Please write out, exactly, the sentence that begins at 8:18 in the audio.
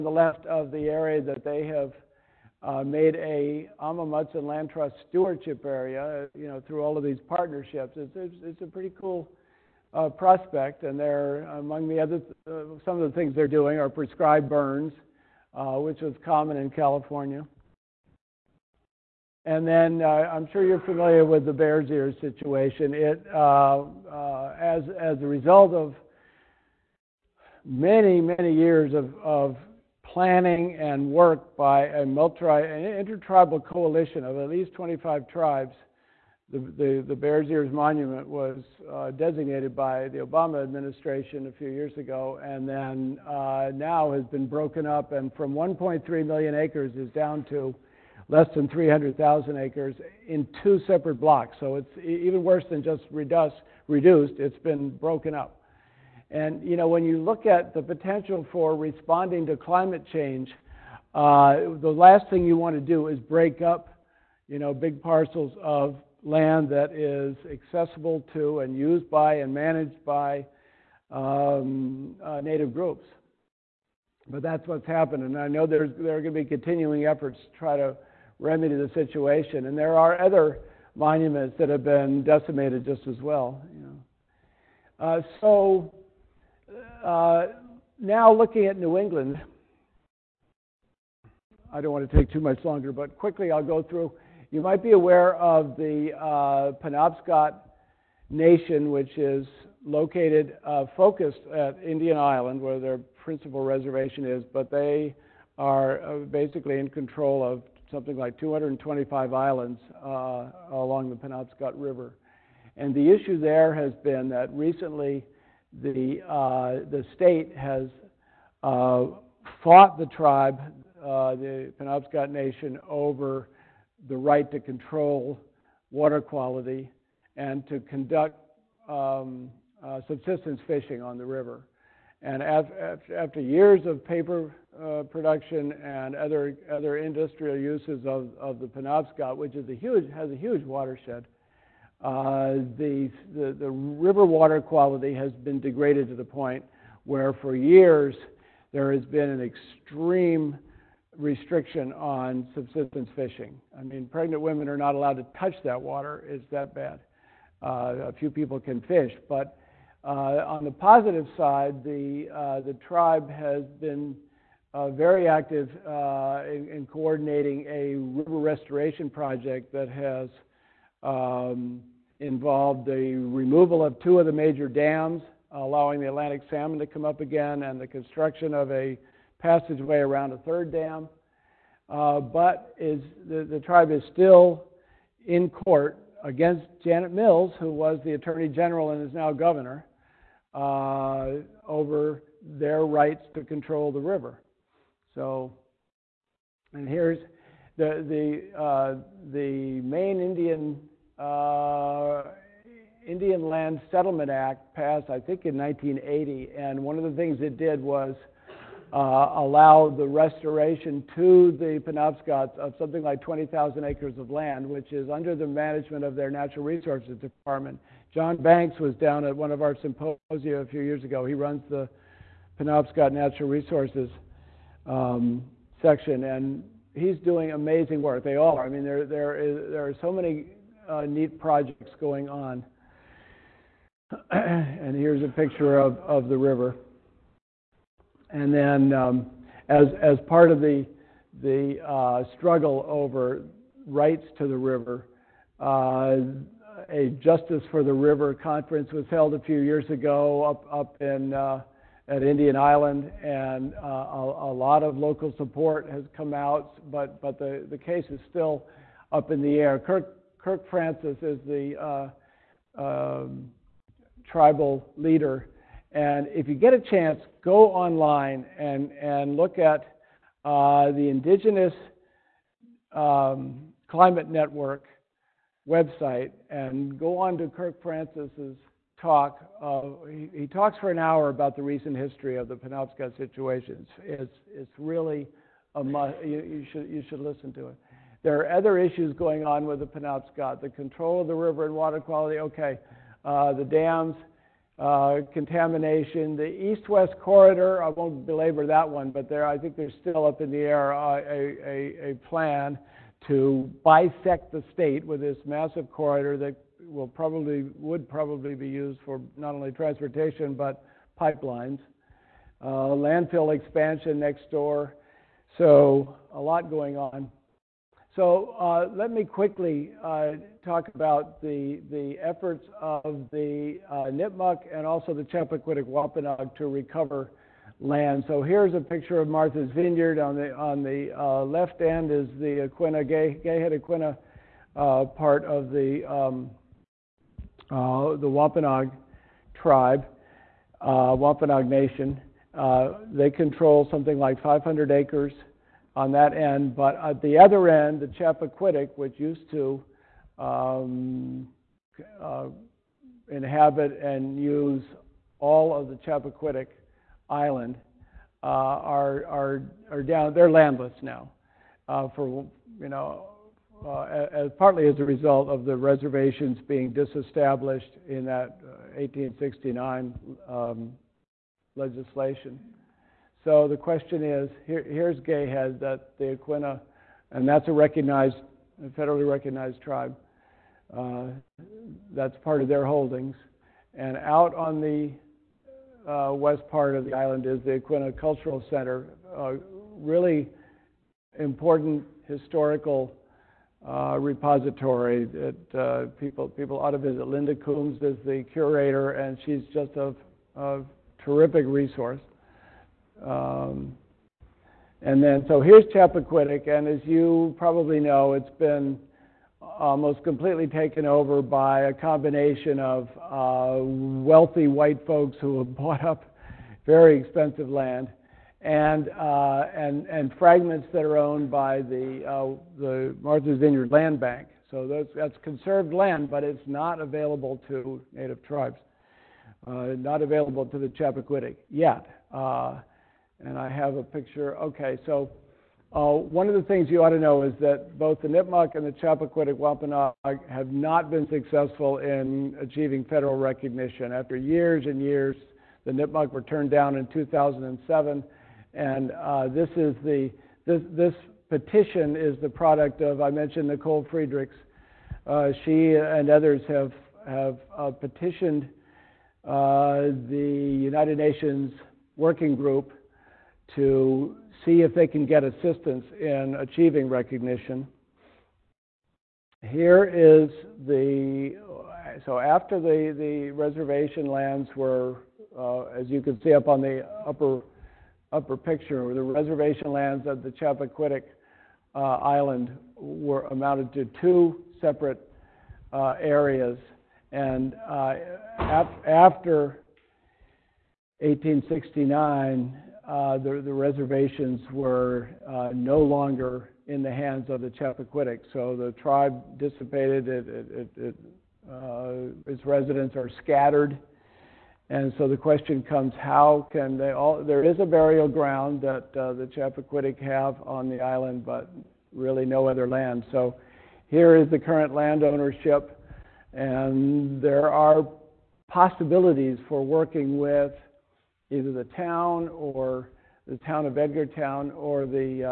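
So the tribe dissipated, it, it, it, uh, its residents are scattered.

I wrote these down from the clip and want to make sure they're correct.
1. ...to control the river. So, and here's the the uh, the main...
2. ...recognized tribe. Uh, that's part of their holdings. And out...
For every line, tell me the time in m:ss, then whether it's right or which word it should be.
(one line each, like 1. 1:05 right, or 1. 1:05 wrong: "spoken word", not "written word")
1. 3:13 right
2. 6:19 right.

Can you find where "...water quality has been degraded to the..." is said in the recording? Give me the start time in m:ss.
2:24.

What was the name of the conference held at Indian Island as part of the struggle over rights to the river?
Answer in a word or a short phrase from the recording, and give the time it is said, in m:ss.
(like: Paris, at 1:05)
Justice for the River, at 4:07.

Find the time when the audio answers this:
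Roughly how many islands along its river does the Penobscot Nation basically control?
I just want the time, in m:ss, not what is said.
1:48.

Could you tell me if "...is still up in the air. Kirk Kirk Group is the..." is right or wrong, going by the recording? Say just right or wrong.
wrong.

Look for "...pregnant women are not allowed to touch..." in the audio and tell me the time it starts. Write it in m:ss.
2:34.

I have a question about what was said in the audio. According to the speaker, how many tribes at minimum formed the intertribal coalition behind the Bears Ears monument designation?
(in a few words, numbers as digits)
25.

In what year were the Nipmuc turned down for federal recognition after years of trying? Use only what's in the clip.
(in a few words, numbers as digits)
2007.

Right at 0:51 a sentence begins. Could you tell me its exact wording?
So it's even worse than just reduced.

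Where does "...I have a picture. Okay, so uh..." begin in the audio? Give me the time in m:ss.
7:13.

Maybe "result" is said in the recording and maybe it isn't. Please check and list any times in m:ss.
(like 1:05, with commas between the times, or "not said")
0:25, 6:05.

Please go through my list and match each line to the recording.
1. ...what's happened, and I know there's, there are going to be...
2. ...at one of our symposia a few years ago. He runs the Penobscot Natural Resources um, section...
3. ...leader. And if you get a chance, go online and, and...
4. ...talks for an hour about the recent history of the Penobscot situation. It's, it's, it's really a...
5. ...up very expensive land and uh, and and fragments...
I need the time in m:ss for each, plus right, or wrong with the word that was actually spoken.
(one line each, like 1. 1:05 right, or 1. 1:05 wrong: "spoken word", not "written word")
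1. 1:14 right
2. 3:39 right
3. 4:24 right
4. 4:40 right
5. 6:56 right.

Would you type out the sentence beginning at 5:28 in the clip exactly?
So here's a picture of Martha's Vineyard.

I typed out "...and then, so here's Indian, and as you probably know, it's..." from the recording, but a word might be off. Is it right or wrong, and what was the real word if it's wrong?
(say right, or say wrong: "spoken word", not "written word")
wrong: "Chappaquiddick", not "Indian".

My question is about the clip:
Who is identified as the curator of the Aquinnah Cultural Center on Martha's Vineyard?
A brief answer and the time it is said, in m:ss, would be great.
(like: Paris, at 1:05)
Linda Coombs, at 6:37.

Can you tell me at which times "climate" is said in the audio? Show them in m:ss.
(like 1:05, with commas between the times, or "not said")
0:59, 4:33.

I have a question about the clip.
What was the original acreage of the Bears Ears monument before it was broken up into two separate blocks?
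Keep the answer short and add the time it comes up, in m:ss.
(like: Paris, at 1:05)
1.3 million acres, at 0:45.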